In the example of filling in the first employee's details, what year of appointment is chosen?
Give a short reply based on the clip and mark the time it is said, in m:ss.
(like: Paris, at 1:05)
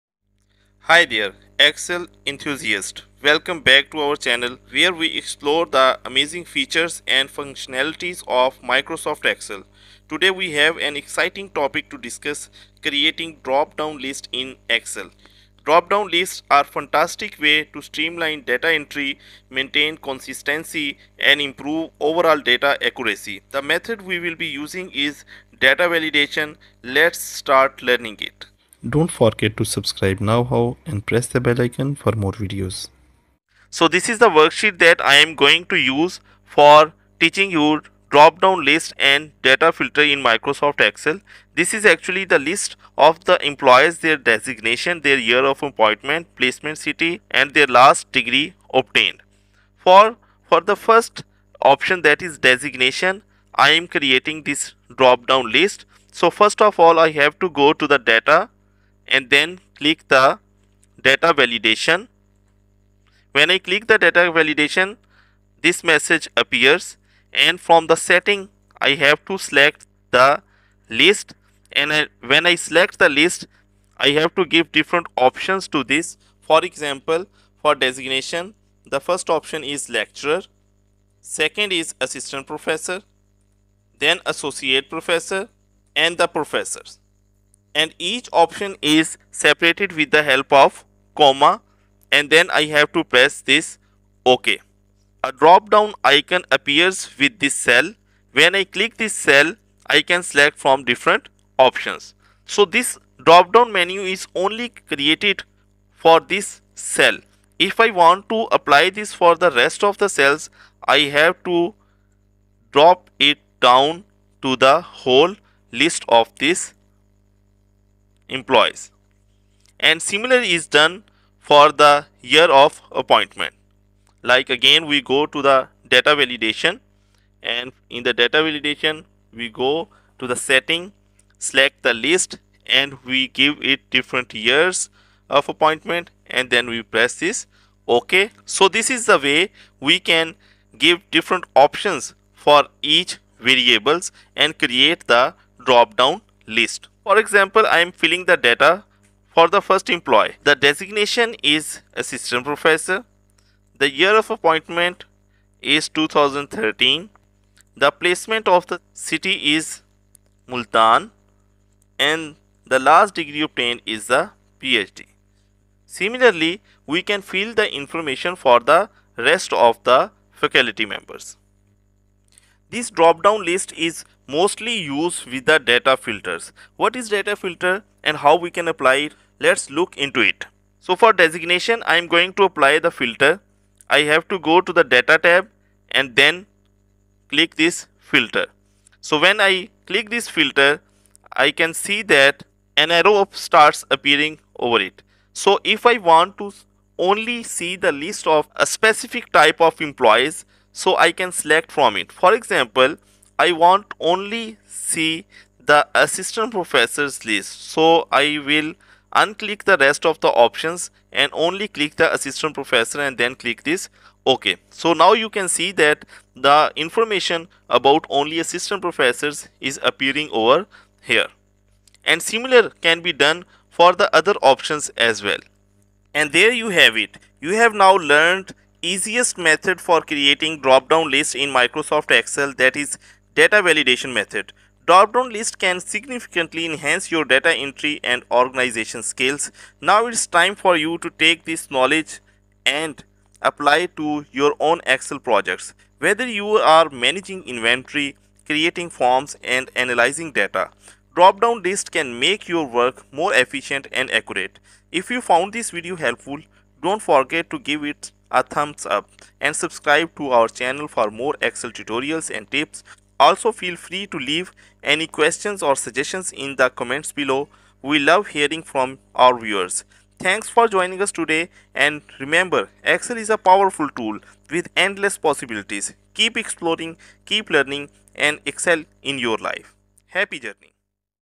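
2013, at 2:35.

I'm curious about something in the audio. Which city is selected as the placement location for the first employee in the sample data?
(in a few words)
Multan.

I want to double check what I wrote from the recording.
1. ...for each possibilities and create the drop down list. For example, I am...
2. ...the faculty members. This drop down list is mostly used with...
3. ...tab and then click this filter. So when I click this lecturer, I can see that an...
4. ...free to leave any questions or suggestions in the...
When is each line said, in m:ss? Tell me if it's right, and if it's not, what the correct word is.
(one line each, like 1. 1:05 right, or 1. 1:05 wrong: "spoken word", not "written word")
1. 2:22 wrong: "variables", not "possibilities"
2. 2:49 right
3. 3:05 wrong: "filter", not "lecturer"
4. 4:23 right.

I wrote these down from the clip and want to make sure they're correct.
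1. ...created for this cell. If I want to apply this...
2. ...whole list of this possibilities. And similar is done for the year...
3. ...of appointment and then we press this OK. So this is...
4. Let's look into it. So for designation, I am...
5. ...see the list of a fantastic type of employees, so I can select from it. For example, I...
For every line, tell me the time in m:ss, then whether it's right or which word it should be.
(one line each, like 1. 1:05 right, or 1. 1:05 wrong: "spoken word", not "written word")
1. 1:44 right
2. 1:54 wrong: "employees", not "possibilities"
3. 2:15 right
4. 2:59 right
5. 3:17 wrong: "specific", not "fantastic".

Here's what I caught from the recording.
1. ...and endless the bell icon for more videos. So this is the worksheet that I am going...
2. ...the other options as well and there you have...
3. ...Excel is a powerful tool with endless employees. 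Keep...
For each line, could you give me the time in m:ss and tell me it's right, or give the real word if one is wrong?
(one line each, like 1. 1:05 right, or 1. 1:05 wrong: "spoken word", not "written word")
1. 0:30 wrong: "press", not "endless"
2. 3:44 right
3. 4:32 wrong: "possibilities", not "employees".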